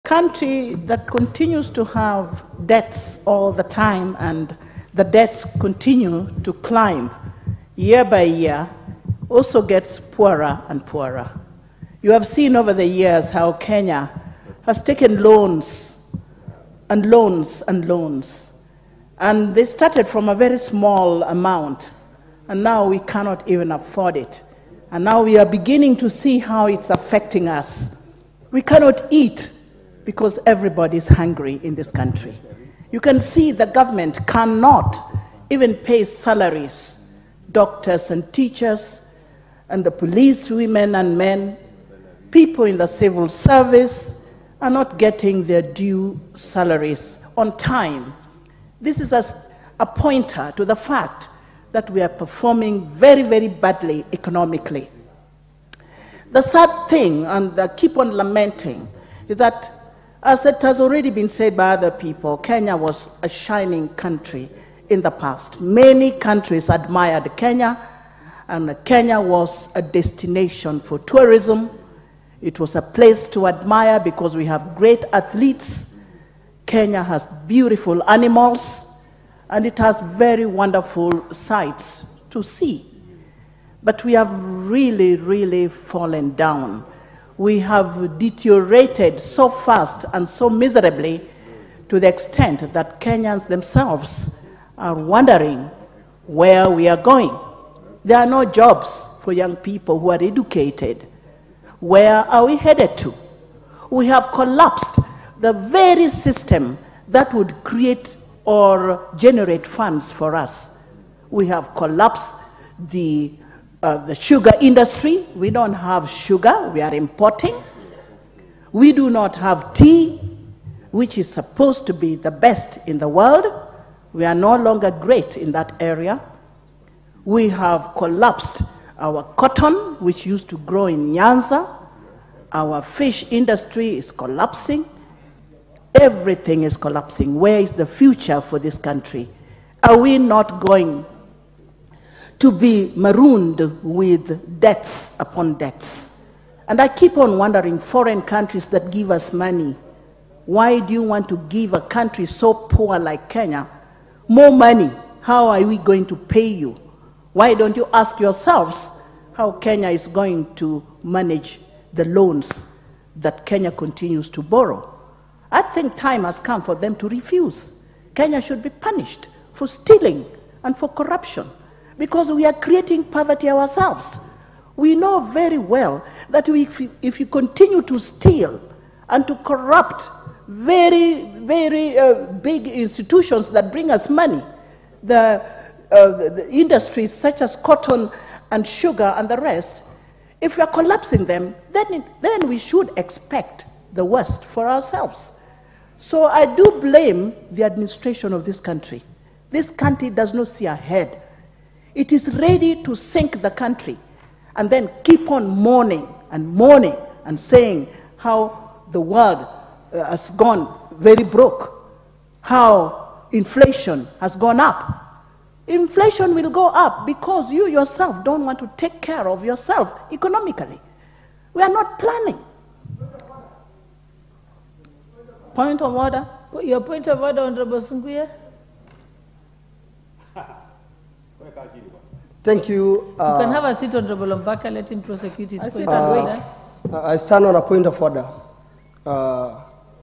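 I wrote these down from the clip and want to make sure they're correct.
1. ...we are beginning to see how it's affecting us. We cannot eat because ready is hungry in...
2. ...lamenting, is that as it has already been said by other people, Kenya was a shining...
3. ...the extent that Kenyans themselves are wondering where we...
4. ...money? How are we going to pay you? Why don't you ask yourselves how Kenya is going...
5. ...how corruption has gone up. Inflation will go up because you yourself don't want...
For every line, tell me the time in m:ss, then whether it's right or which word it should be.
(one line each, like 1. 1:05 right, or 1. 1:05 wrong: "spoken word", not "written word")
1. 0:25 wrong: "everybody", not "ready"
2. 0:58 right
3. 1:31 right
4. 2:34 right
5. 3:32 wrong: "inflation", not "corruption".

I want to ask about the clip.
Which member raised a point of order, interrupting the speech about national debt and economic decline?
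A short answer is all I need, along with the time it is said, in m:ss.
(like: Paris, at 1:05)
Sunguya, at 3:47.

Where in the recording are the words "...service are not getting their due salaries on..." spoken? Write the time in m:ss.
0:43.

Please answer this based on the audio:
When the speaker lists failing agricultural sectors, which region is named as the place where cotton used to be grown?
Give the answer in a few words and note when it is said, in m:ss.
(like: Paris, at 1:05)
Nyanza, at 2:11.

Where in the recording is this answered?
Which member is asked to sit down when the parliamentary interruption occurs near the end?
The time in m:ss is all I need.
3:54.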